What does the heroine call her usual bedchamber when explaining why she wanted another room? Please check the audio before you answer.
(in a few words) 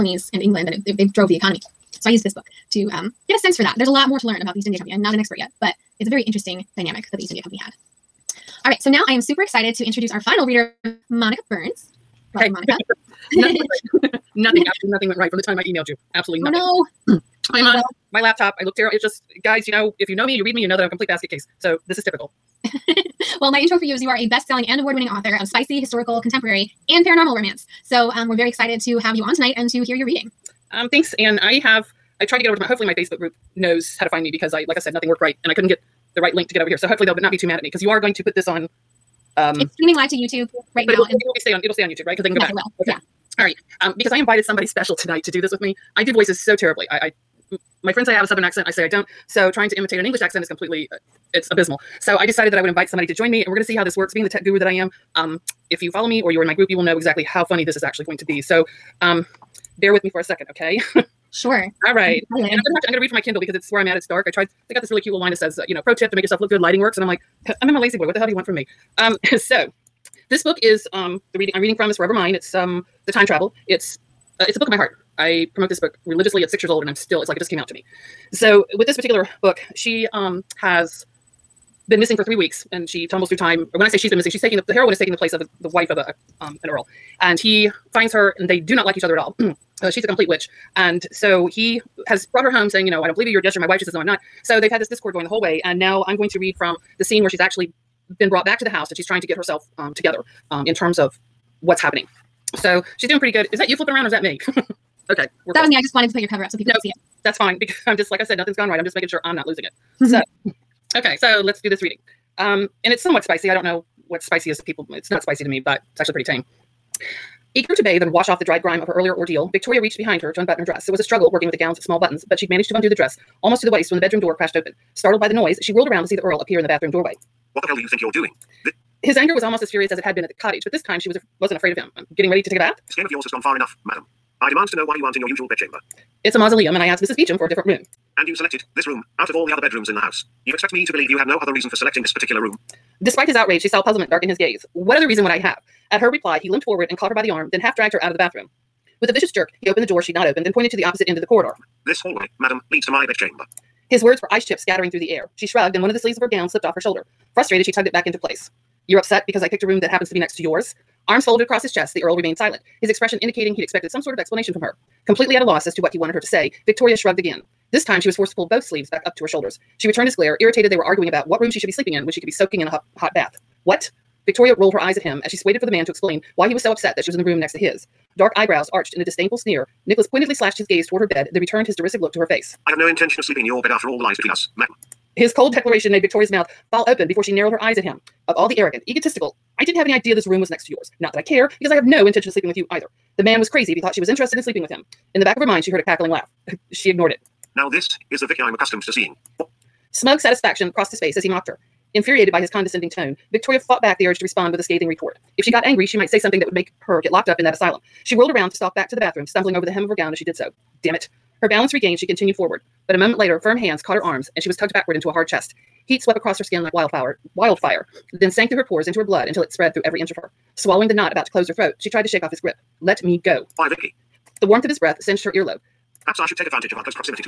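A mausoleum.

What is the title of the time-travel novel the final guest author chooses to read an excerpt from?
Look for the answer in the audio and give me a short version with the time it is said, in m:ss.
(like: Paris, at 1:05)
Forever Mine, at 1:11.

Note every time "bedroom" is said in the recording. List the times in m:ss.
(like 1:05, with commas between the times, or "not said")
2:03, 2:19.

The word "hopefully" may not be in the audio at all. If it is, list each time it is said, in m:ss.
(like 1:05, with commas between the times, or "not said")
0:32, 0:36.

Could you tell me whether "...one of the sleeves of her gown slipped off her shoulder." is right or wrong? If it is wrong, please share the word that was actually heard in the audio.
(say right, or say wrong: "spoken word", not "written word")
right.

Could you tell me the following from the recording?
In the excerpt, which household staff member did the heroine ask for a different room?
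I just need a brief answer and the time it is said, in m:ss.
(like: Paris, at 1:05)
Mrs. Beecham, at 2:17.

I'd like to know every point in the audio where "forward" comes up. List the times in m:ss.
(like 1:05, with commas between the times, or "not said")
2:26, 3:32.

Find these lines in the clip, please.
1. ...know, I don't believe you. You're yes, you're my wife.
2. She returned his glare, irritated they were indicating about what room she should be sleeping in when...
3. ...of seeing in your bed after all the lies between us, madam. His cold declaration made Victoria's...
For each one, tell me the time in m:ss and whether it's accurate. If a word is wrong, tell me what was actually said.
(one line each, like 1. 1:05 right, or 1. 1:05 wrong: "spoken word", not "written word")
1. 1:32 right
2. 2:49 wrong: "arguing", not "indicating"
3. 3:03 wrong: "sleeping", not "seeing".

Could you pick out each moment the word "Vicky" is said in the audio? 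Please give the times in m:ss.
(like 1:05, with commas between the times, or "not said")
3:18, 3:43.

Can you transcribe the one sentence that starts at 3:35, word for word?
Heat swept across her skin like wildfire.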